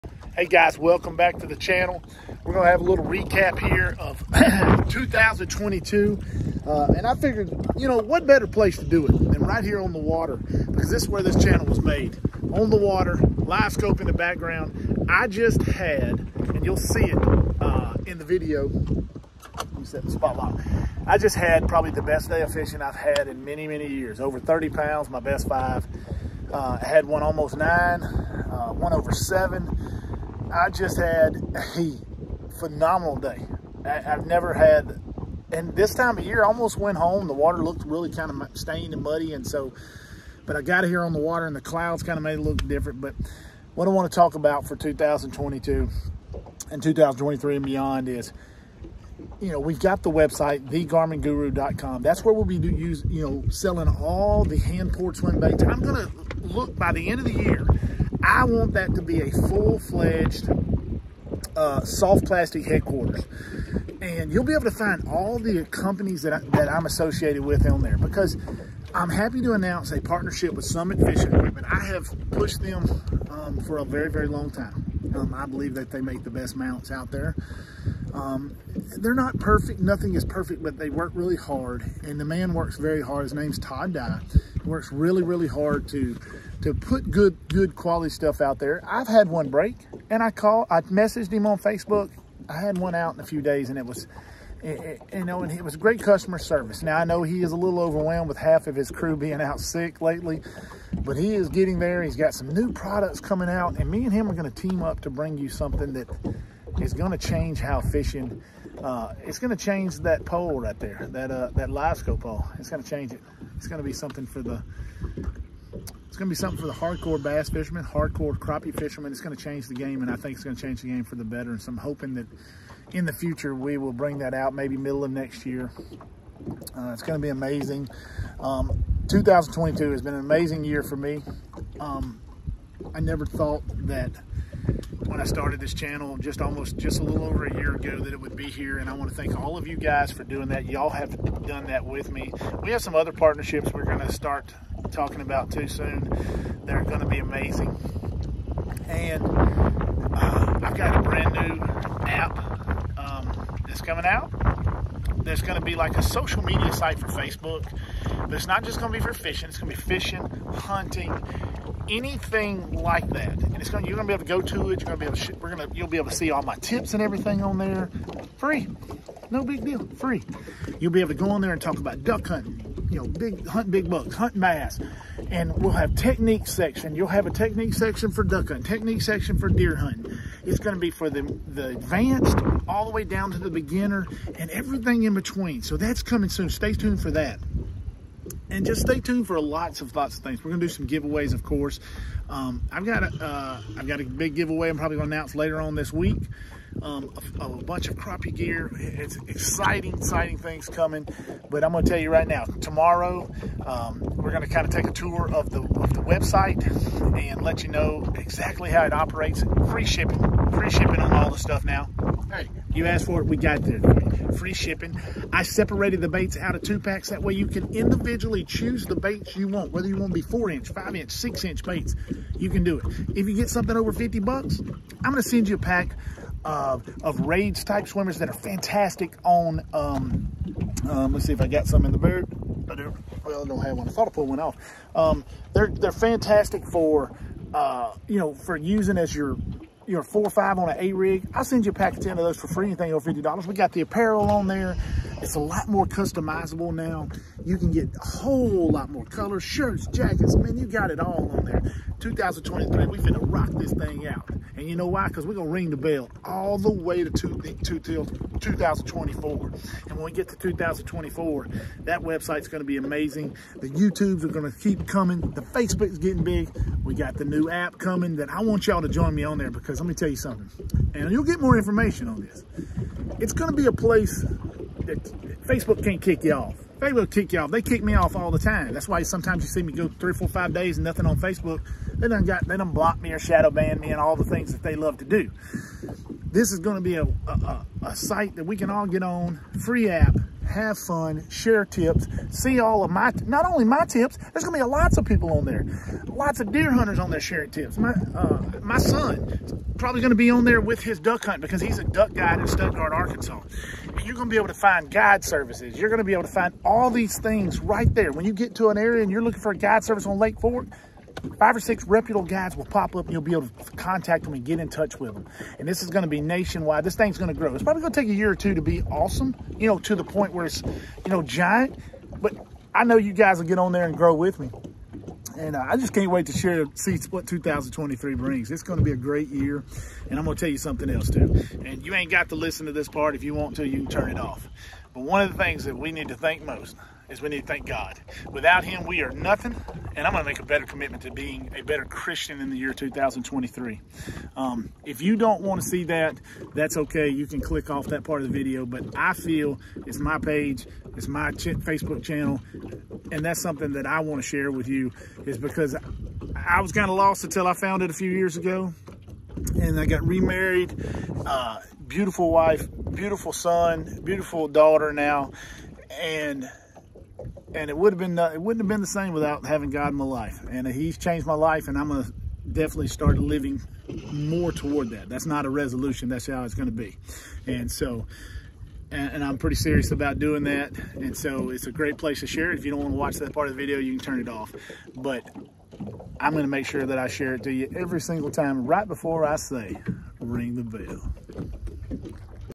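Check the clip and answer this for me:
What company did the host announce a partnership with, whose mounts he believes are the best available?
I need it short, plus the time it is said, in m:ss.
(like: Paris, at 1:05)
Summit Fishing Equipment, at 1:10.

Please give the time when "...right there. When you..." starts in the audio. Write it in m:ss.
5:07.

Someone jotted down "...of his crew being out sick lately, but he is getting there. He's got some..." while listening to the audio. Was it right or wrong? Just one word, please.
right.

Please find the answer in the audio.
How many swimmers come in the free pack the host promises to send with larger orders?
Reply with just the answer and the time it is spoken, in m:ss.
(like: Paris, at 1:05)
10, at 4:02.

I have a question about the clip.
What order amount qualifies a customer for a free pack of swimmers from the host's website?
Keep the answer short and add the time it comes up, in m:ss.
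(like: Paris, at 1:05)
$50, at 3:43.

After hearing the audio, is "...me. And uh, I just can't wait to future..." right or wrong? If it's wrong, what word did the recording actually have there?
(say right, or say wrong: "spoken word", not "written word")
wrong: "share", not "future".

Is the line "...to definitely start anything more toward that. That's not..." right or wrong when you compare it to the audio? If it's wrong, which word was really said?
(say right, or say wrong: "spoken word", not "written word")
wrong: "living", not "anything".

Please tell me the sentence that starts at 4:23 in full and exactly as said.
The YouTubes are going to keep coming.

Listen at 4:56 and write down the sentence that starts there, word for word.
Lots of deer hunters on there sharing tips.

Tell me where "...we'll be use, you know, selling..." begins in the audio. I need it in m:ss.
0:52.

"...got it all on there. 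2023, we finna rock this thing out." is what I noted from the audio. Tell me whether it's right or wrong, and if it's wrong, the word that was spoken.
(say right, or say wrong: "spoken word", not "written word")
right.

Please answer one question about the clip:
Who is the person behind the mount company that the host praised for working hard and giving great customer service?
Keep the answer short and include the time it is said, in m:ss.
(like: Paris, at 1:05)
Todd Dye, at 1:23.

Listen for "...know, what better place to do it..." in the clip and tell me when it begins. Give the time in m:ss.
0:07.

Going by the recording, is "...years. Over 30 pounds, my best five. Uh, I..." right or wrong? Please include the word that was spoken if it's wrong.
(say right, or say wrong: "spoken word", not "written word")
right.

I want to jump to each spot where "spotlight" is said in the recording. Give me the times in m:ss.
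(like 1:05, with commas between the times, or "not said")
0:19.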